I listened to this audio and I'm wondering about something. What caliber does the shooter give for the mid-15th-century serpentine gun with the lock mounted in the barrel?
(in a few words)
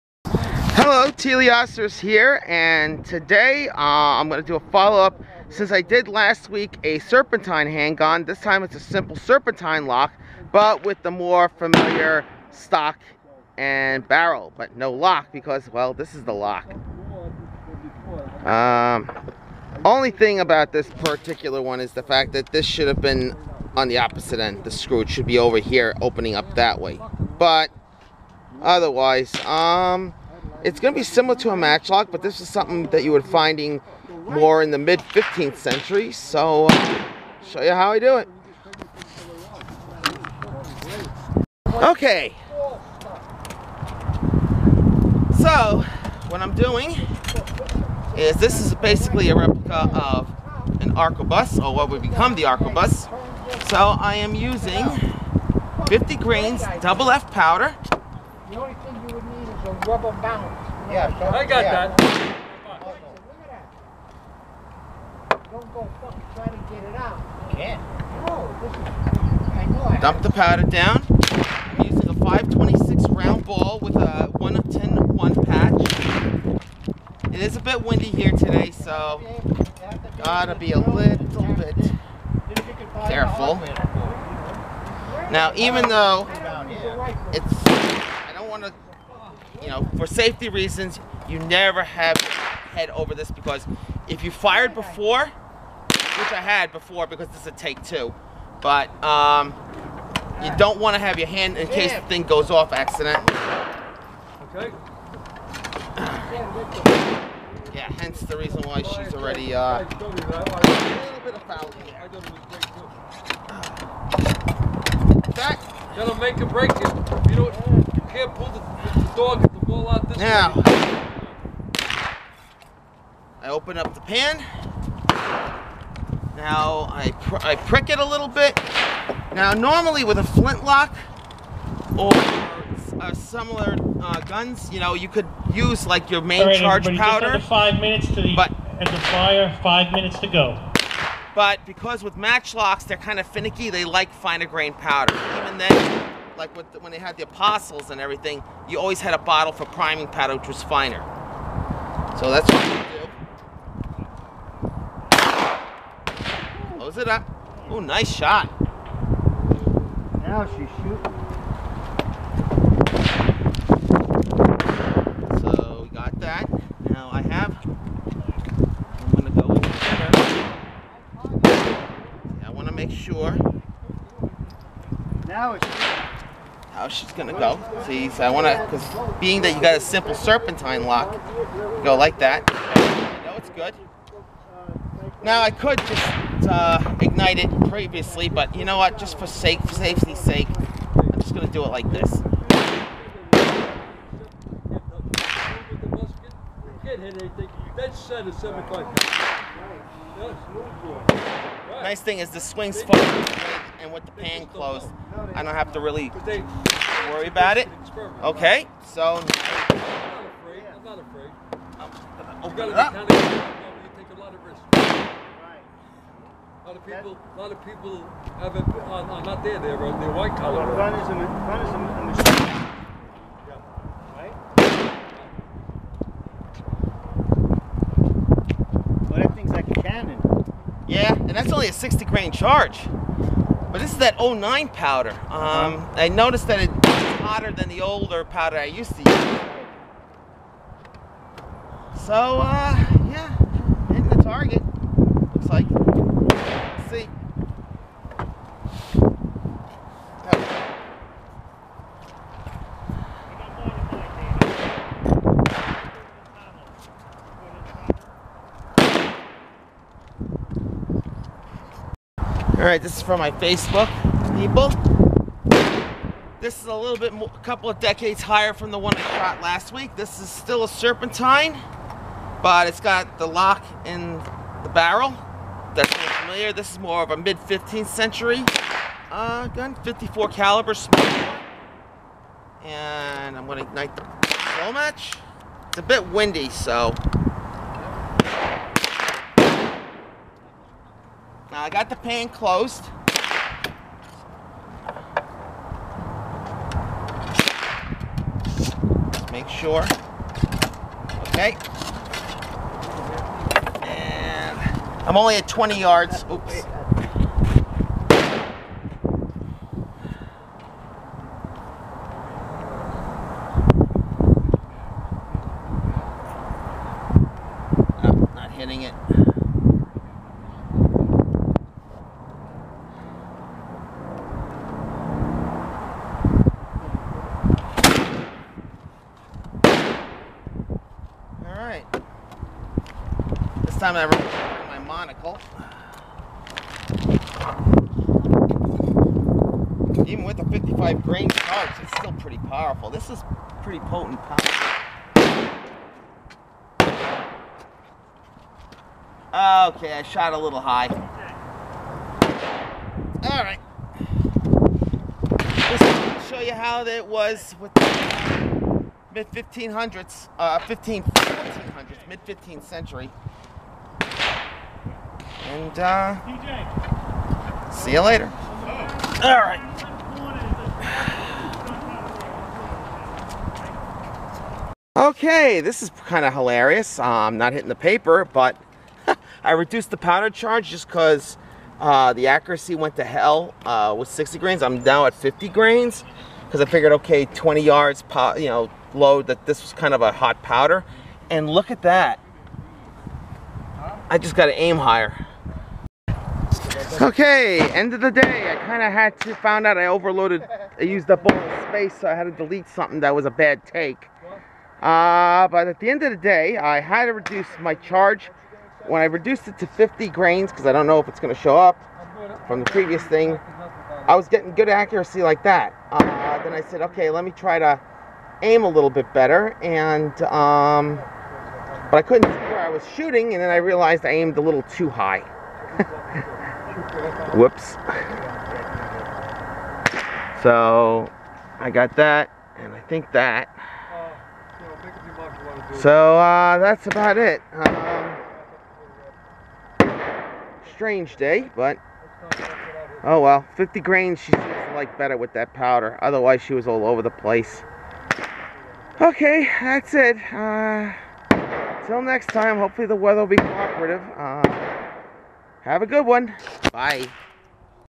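54.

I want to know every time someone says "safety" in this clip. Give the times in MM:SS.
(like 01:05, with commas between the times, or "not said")
01:30, 03:09.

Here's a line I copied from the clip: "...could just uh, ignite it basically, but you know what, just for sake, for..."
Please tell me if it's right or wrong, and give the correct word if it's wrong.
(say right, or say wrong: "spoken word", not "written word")
wrong: "previously", not "basically".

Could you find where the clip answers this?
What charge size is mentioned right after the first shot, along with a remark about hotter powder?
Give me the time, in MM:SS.
03:51.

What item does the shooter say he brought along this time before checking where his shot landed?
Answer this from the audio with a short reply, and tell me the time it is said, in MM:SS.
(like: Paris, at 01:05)
monocle, at 05:34.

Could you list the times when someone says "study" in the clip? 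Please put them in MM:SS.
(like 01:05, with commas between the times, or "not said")
not said.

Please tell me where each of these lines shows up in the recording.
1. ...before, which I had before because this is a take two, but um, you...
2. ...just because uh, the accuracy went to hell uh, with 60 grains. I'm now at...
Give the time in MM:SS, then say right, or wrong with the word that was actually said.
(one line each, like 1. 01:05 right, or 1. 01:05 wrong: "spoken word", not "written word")
1. 01:34 right
2. 06:20 right.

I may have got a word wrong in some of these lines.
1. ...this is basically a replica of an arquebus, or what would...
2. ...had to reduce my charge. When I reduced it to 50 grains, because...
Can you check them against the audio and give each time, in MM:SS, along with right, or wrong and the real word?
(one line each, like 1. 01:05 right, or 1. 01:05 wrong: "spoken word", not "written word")
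1. 00:48 right
2. 06:46 right.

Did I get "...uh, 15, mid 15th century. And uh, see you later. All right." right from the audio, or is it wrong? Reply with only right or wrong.
right.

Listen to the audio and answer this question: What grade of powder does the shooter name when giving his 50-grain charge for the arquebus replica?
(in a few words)
double F.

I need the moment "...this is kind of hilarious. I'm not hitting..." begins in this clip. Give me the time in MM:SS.
06:15.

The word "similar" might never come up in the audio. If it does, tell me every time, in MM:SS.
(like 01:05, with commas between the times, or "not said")
00:31, 02:13.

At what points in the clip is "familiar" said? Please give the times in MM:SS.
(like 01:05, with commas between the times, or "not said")
00:11, 04:36.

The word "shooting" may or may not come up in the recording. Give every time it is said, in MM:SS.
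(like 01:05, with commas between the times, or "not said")
02:40, 07:02.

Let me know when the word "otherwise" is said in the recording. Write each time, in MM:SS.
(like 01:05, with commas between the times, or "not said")
00:28, 07:26.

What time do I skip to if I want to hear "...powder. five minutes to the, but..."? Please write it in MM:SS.
02:16.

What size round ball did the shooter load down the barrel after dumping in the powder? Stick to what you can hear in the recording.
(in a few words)
526.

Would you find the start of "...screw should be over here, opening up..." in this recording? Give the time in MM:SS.
00:24.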